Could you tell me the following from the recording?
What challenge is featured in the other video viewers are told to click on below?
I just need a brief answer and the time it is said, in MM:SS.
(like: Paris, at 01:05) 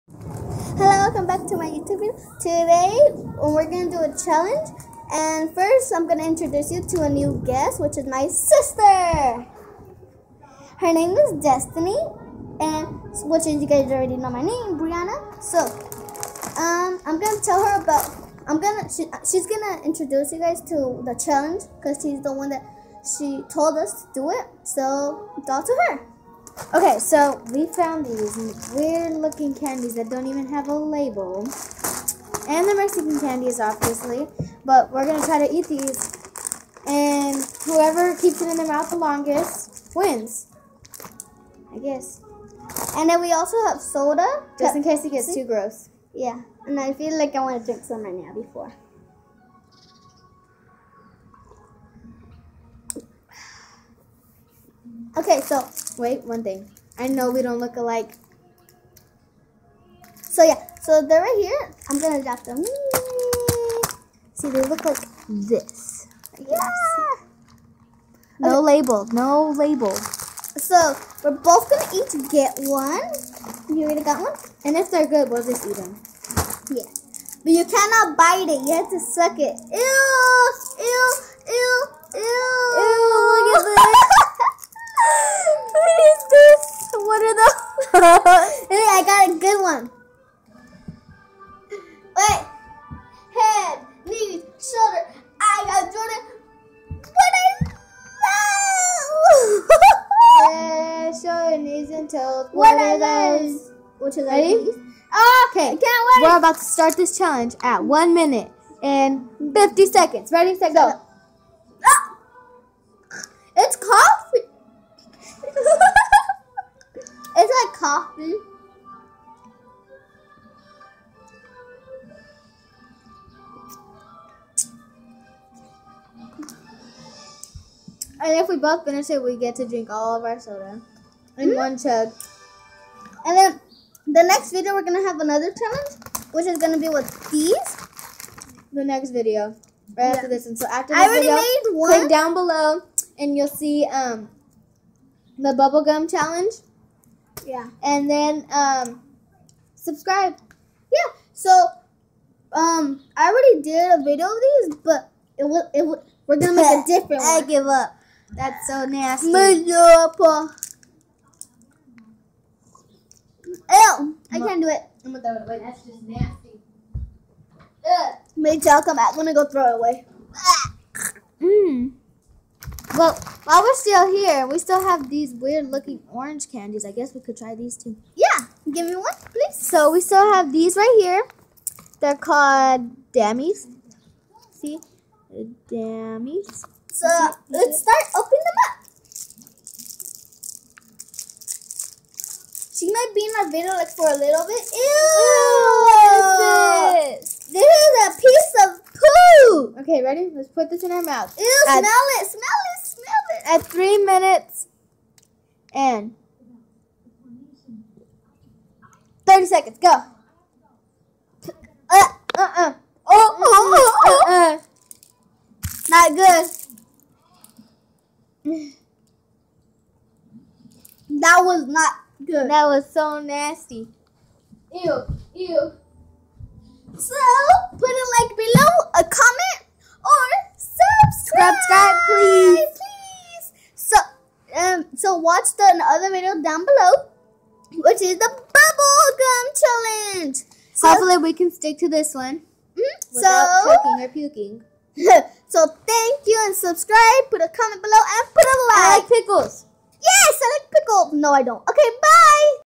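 bubblegum challenge, at 02:25.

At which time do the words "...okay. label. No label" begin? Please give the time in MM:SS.
01:08.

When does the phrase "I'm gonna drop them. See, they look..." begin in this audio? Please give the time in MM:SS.
01:01.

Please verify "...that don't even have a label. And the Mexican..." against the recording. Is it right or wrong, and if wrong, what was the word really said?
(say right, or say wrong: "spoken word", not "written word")
right.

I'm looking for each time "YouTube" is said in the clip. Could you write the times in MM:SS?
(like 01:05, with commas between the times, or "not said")
00:01.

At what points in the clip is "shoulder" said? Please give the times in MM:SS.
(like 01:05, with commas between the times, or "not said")
01:34, 01:41.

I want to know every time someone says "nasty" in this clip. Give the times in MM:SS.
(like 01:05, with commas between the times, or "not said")
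02:38, 02:46, 03:43.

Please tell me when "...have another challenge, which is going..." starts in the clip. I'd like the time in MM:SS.
02:15.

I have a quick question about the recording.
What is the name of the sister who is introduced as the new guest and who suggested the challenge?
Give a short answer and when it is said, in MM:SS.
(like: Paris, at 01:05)
Destiny, at 00:11.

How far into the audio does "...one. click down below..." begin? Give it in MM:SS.
02:21.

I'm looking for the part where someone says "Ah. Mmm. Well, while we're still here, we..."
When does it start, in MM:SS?
02:50.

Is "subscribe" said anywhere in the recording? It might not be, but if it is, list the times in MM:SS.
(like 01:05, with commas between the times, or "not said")
02:29, 04:06.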